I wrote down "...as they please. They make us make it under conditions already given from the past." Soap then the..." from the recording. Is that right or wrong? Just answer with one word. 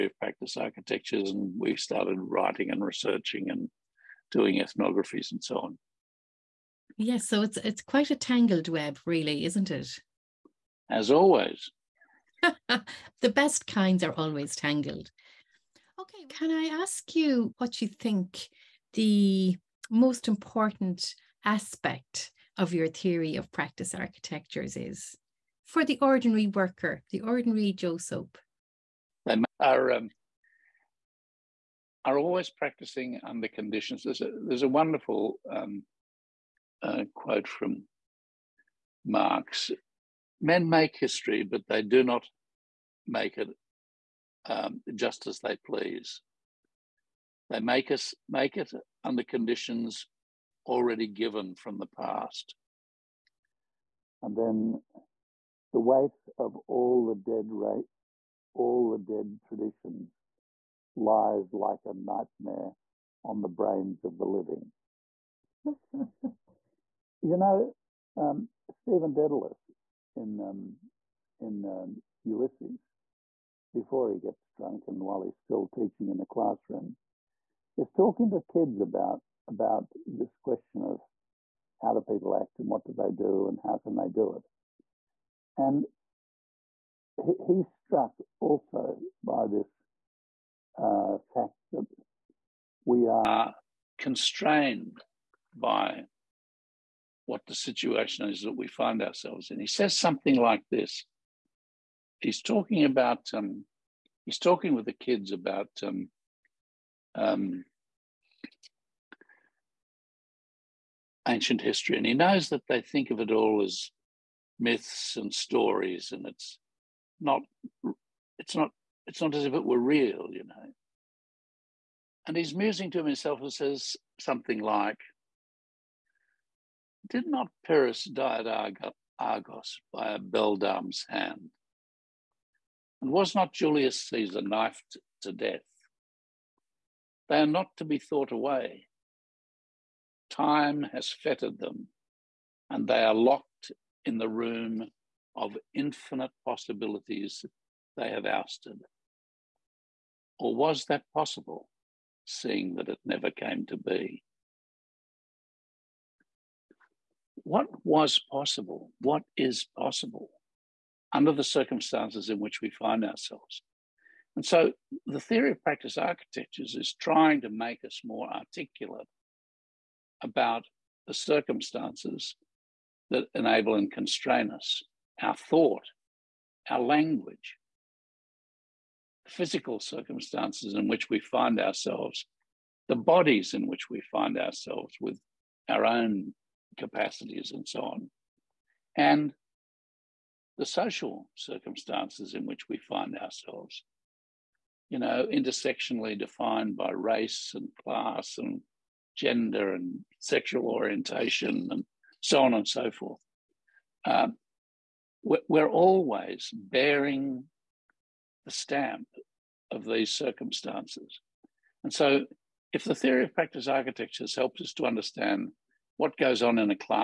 wrong.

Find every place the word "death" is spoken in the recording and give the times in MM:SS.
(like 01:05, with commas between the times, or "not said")
02:15.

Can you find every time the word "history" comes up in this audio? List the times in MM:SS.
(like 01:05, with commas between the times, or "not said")
00:40, 01:51.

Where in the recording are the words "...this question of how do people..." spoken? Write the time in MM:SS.
01:20.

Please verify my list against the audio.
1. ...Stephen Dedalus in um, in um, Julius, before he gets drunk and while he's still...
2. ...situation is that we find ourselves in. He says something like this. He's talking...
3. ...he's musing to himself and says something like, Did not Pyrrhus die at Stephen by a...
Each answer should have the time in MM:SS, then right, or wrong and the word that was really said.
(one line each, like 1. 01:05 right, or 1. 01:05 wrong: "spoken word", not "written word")
1. 01:08 wrong: "Ulysses", not "Julius"
2. 01:37 right
3. 02:02 wrong: "Argos", not "Stephen".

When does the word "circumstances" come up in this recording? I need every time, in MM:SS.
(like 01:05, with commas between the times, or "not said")
02:41, 02:51, 02:59, 03:11, 03:30.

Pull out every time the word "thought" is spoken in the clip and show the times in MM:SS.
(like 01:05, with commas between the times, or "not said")
02:17, 02:55.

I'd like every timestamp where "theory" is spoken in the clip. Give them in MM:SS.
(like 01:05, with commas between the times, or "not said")
00:22, 02:45, 03:32.